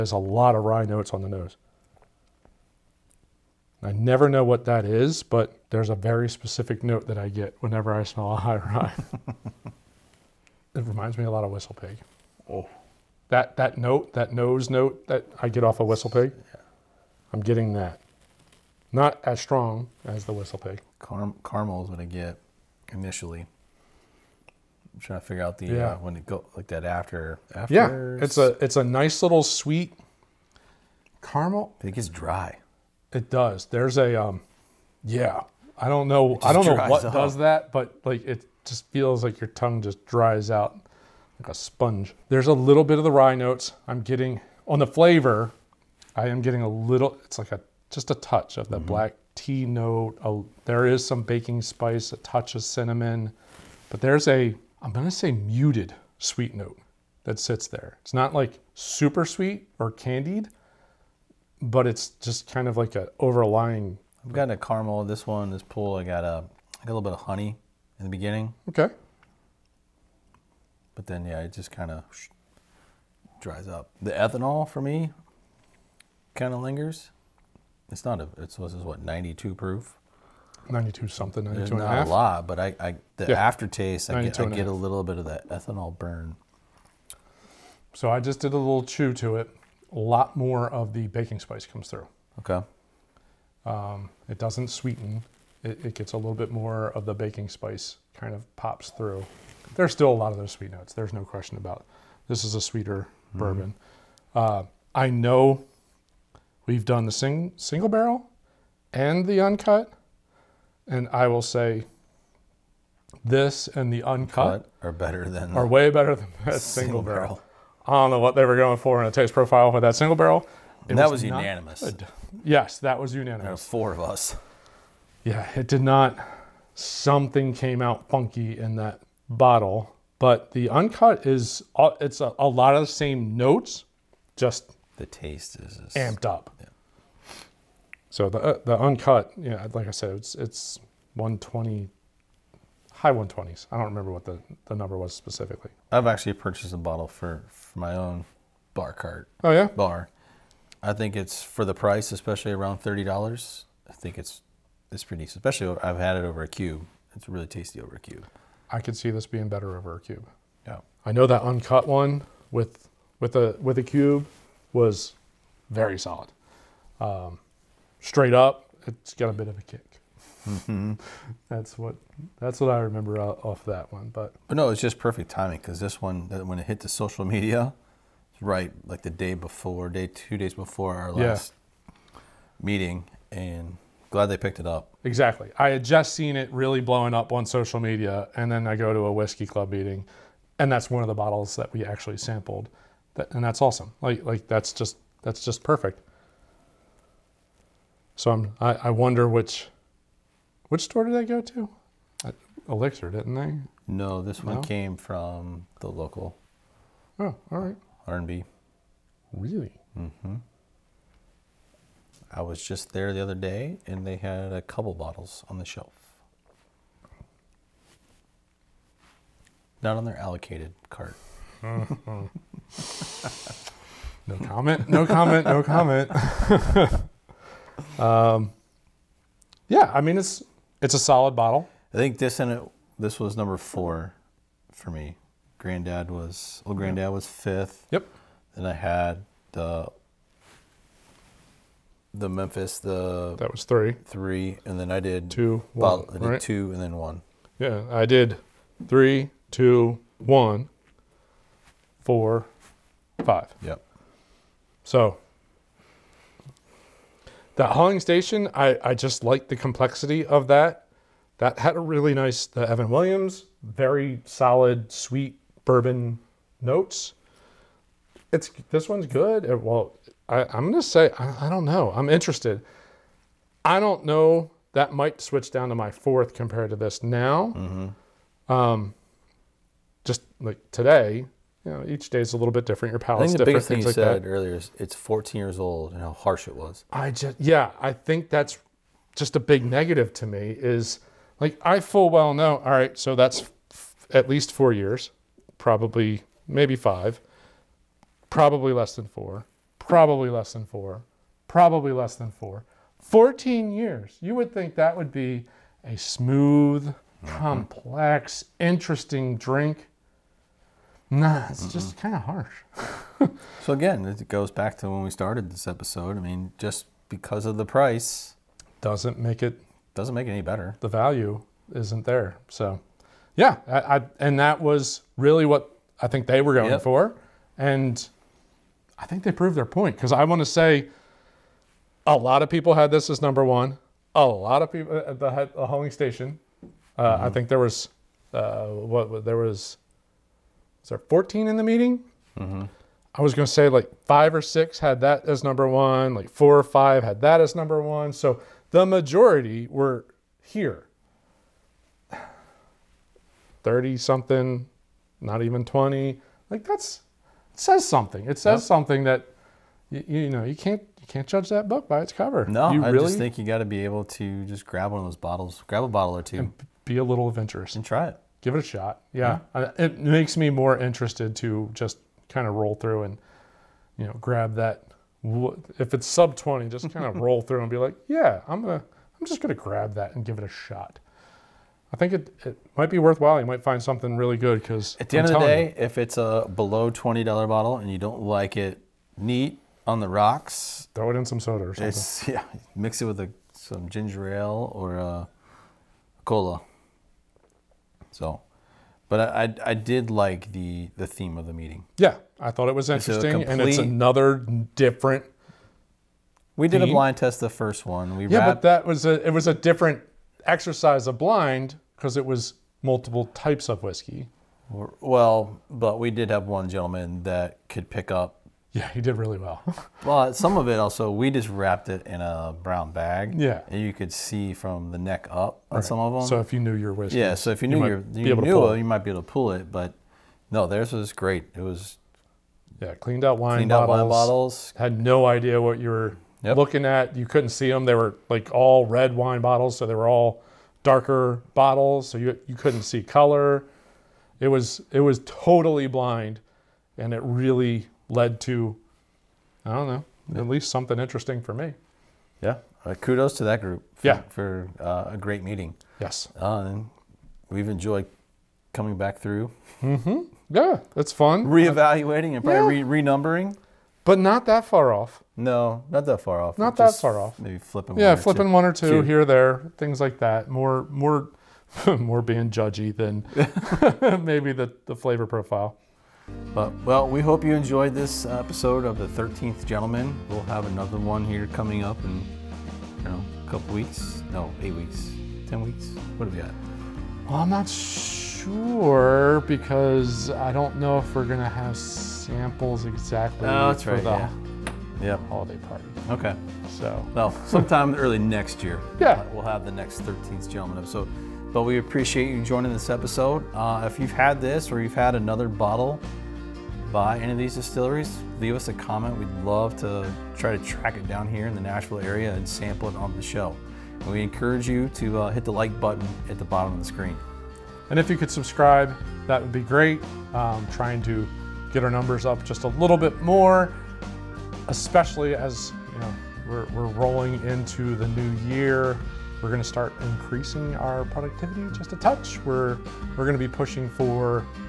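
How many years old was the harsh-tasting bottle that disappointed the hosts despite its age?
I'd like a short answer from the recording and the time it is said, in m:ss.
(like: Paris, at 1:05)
14, at 4:44.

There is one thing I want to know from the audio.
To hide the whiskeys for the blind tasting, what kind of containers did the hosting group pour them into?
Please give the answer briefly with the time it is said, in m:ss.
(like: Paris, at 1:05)
Red wine bottles, at 7:18.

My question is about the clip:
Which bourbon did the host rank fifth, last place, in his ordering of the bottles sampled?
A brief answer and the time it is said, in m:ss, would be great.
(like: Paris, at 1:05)
Old Grand-Dad, at 3:56.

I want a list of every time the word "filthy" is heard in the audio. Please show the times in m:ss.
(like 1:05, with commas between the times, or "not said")
not said.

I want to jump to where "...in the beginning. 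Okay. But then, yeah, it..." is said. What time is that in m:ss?
1:07.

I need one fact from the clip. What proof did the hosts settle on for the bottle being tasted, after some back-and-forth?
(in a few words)
92.5.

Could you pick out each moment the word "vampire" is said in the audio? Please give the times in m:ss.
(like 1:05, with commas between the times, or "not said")
not said.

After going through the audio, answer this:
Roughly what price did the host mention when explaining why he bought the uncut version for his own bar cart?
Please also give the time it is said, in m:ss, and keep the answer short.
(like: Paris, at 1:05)
$30, at 2:32.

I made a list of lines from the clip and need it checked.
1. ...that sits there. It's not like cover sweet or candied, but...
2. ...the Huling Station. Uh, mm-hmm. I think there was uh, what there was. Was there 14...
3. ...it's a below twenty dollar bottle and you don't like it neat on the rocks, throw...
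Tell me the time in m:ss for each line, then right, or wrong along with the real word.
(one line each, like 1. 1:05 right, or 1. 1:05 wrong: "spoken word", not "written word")
1. 0:57 wrong: "super", not "cover"
2. 5:35 right
3. 6:25 right.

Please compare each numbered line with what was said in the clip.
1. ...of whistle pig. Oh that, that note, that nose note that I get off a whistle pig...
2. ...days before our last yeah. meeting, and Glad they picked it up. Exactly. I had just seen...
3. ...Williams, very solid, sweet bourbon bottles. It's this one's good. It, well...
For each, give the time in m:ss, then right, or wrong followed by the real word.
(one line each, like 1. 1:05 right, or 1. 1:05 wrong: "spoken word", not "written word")
1. 0:11 right
2. 3:00 right
3. 4:22 wrong: "notes", not "bottles".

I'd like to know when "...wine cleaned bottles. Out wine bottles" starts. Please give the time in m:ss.
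7:13.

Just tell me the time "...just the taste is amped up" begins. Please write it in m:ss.
2:14.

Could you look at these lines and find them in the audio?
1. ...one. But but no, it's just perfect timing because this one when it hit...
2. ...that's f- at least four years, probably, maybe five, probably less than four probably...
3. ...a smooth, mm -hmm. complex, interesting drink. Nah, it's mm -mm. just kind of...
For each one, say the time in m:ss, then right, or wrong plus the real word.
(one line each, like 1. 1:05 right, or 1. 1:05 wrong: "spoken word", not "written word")
1. 2:53 right
2. 4:53 right
3. 5:05 right.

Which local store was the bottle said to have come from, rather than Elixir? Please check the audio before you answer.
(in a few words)
R&B.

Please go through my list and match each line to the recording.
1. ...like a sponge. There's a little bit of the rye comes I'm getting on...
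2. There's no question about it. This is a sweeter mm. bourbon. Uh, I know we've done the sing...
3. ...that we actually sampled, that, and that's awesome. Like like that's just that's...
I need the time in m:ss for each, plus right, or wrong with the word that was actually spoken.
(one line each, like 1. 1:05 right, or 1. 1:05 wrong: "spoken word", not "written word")
1. 0:41 wrong: "notes", not "comes"
2. 1:40 right
3. 3:11 right.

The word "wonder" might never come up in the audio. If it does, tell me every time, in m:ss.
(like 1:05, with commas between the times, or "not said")
3:18.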